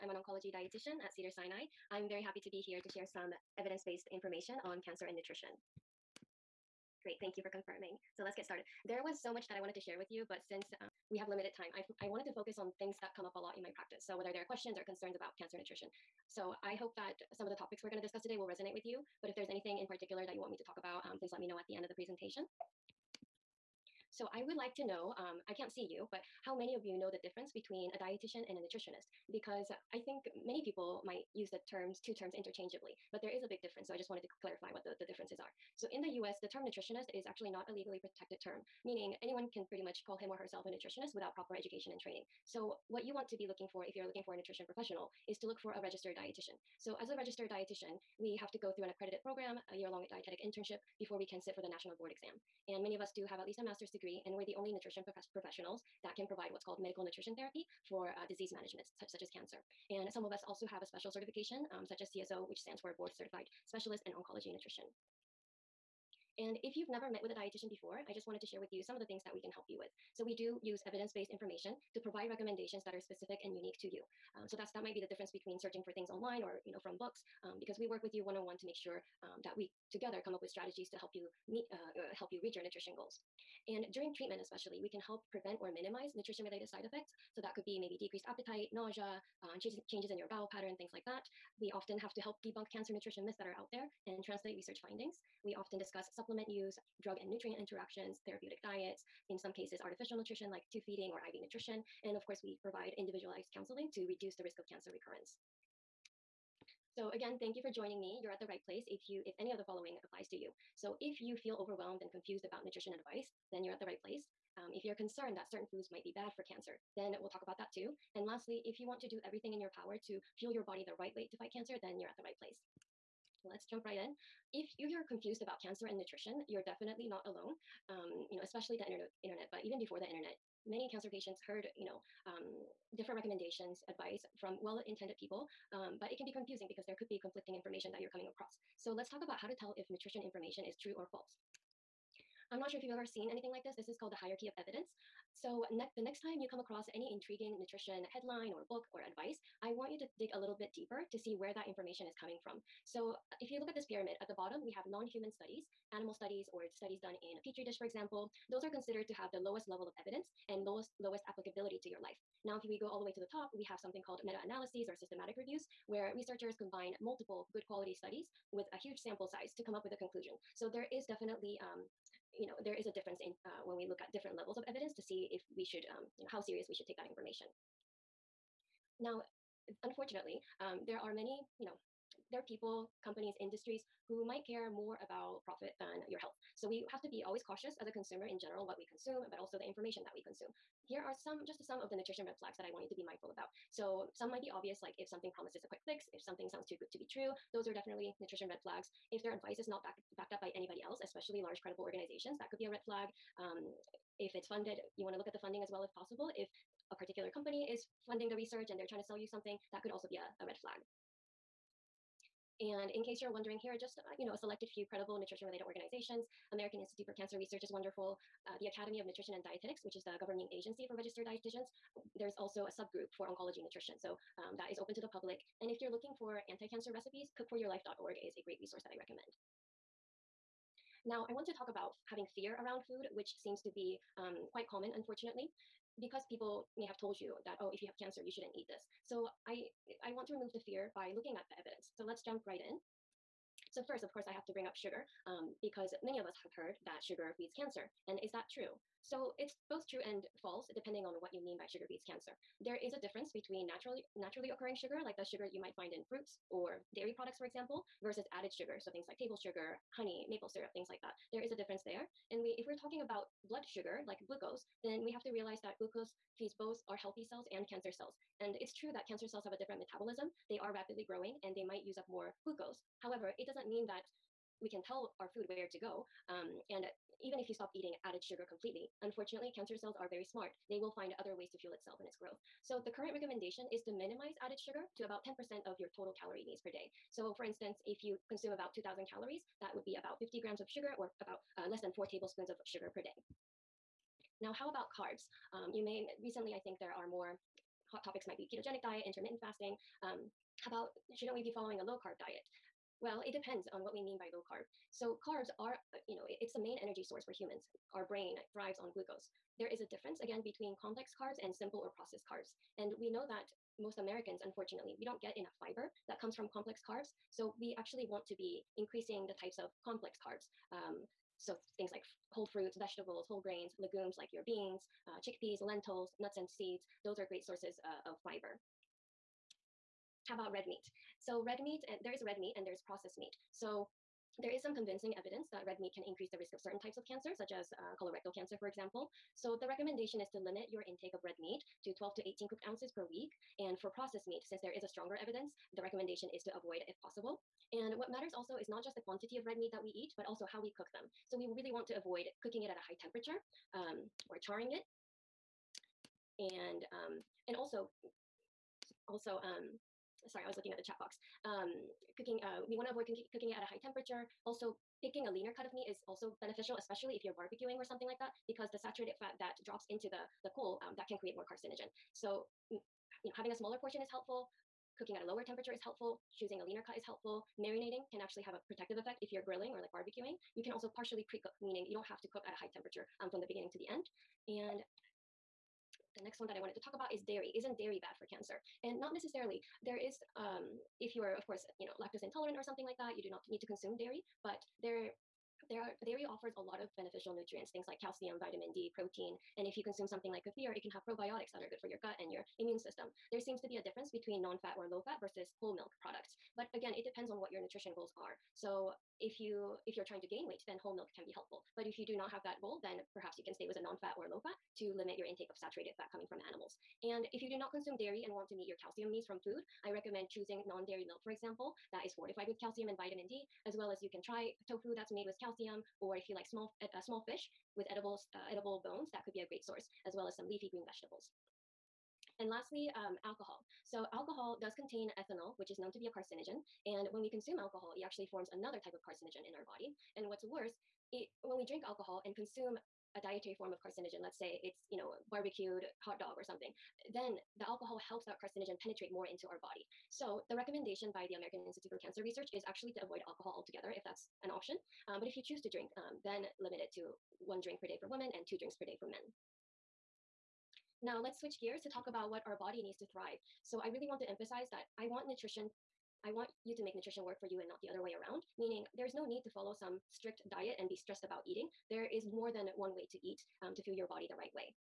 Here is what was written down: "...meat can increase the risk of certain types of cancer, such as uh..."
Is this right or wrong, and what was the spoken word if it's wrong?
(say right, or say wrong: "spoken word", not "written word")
right.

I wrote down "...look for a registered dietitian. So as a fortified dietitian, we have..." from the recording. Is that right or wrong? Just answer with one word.
wrong.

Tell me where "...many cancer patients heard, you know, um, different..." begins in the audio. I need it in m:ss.
2:10.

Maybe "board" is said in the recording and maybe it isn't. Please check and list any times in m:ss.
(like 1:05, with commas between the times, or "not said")
0:51, 1:02.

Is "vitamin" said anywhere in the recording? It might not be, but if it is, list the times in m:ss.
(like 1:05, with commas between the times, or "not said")
6:38, 7:02.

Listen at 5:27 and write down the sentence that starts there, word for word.
Those are great sources uh, of fiber.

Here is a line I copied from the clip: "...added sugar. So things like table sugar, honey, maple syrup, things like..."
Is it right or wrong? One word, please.
right.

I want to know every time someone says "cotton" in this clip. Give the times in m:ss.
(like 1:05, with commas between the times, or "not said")
not said.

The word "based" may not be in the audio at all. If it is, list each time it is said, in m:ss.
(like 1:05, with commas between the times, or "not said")
0:03, 1:10.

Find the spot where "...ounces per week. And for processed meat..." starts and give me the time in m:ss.
5:42.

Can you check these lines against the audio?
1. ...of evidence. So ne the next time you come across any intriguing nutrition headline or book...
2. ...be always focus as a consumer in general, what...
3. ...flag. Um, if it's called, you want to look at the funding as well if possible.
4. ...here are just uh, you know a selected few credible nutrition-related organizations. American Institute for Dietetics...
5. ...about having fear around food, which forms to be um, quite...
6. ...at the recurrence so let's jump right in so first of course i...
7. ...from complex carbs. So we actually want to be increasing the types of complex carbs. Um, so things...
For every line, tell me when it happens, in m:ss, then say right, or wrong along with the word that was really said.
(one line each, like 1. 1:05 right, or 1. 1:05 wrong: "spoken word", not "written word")
1. 2:24 right
2. 3:07 wrong: "cautious", not "focus"
3. 3:22 wrong: "funded", not "called"
4. 3:33 wrong: "Cancer", not "Dietetics"
5. 3:51 wrong: "seems", not "forms"
6. 4:01 wrong: "evidence", not "recurrence"
7. 5:16 right.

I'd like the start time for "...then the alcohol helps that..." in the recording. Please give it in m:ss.
7:27.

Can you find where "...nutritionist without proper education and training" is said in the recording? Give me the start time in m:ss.
0:40.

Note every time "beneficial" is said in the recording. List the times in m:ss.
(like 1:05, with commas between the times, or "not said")
6:06, 6:36.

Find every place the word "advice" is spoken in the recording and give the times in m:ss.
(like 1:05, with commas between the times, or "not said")
1:52, 2:13, 2:29, 3:19.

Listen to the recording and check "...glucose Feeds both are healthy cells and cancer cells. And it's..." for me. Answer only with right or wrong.
right.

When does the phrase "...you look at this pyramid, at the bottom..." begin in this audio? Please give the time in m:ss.
2:33.